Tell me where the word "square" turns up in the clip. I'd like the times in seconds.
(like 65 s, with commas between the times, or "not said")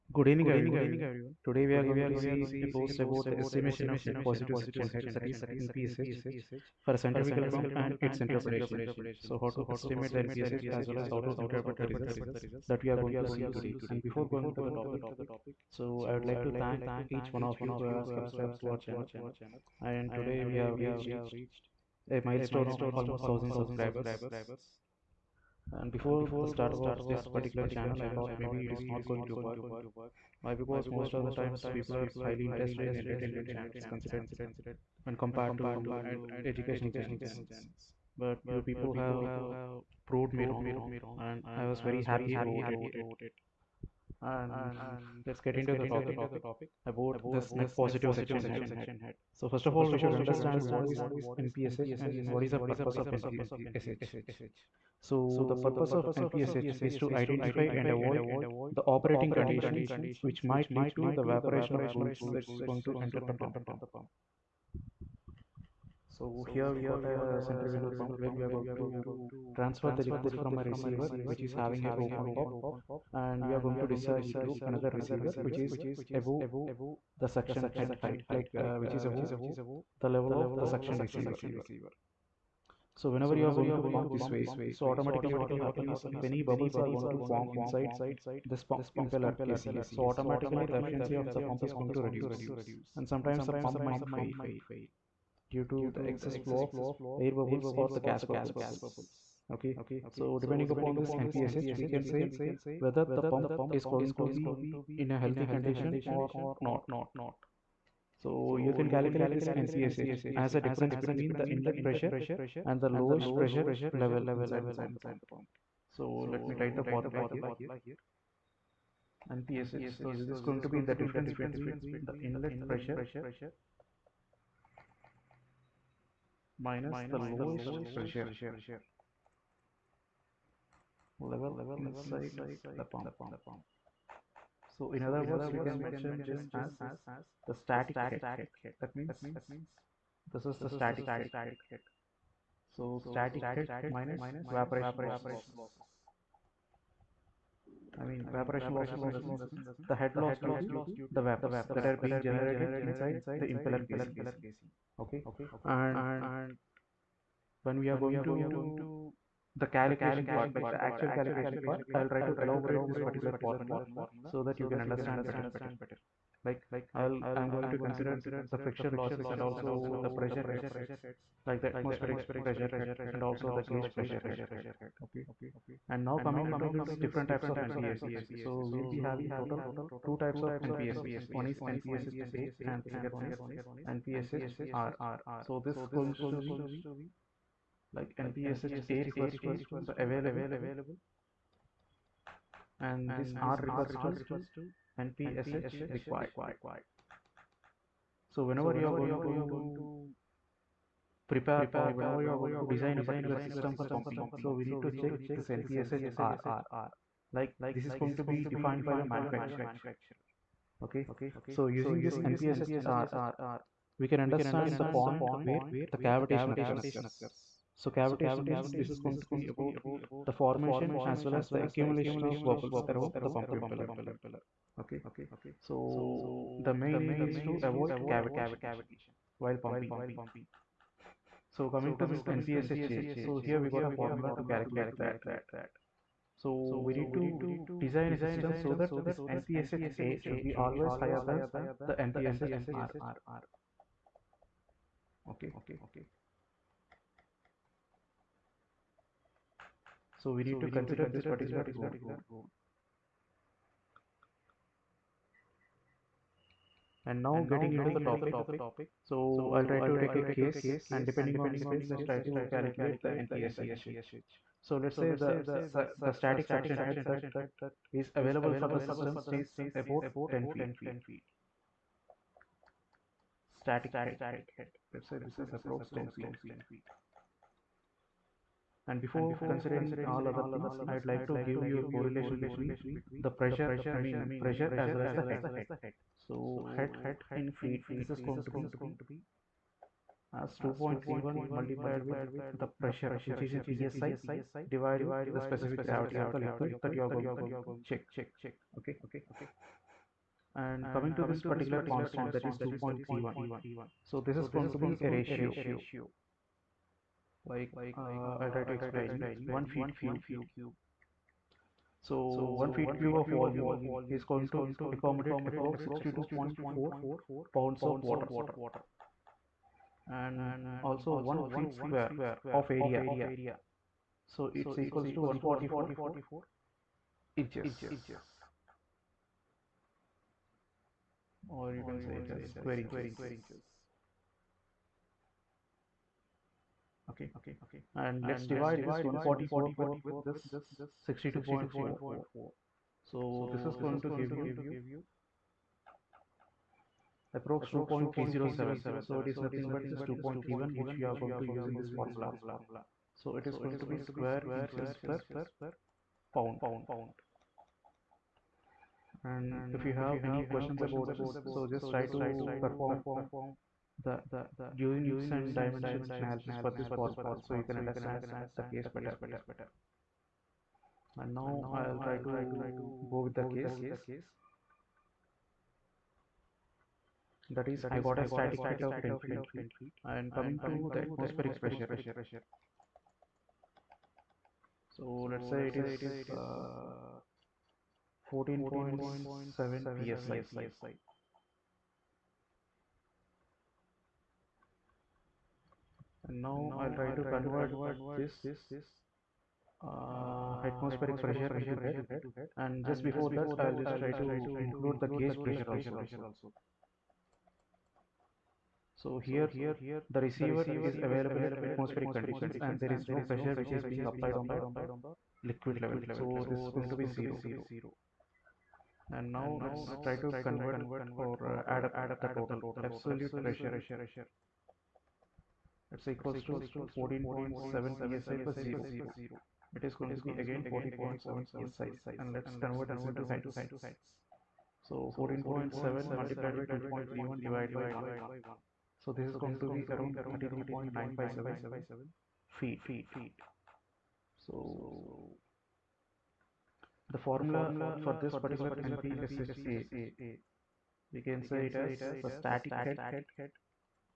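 321 s, 332 s, 353 s.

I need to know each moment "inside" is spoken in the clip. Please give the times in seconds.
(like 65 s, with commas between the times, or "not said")
87 s, 114 s, 131 s, 152 s.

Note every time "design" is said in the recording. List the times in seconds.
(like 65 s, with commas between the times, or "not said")
202 s, 237 s.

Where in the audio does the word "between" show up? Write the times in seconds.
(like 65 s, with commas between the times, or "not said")
111 s, 121 s, 282 s.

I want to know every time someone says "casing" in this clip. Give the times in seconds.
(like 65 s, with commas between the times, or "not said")
89 s, 153 s.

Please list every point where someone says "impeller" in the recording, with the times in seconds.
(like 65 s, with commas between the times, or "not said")
89 s, 153 s, 223 s.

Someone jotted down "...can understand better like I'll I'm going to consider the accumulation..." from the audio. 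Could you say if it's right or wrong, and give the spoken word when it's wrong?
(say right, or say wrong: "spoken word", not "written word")
wrong: "friction", not "accumulation".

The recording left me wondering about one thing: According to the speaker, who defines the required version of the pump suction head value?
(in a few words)
the manufacturer.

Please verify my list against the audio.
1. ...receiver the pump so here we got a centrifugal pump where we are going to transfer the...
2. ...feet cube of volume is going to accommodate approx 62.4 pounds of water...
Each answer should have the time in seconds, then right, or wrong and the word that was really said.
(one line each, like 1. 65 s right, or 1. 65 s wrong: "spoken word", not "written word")
1. 63 s wrong: "enter", not "receiver"
2. 312 s right.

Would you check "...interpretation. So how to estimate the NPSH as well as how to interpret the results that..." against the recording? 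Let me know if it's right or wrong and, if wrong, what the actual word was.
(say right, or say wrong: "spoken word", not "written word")
right.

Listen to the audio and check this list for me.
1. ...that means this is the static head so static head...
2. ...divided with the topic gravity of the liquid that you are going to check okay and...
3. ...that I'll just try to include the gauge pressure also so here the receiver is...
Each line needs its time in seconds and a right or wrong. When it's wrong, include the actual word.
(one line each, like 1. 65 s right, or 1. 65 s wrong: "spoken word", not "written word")
1. 138 s right
2. 294 s wrong: "specific", not "topic"
3. 403 s right.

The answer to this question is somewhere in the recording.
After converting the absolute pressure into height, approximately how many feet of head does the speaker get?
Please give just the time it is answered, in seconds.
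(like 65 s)
440 s.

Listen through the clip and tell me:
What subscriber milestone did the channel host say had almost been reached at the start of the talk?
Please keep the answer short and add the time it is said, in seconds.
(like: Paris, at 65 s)
1000 subscribers, at 23 s.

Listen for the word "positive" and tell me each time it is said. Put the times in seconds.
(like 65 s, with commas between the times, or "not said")
4 s, 47 s.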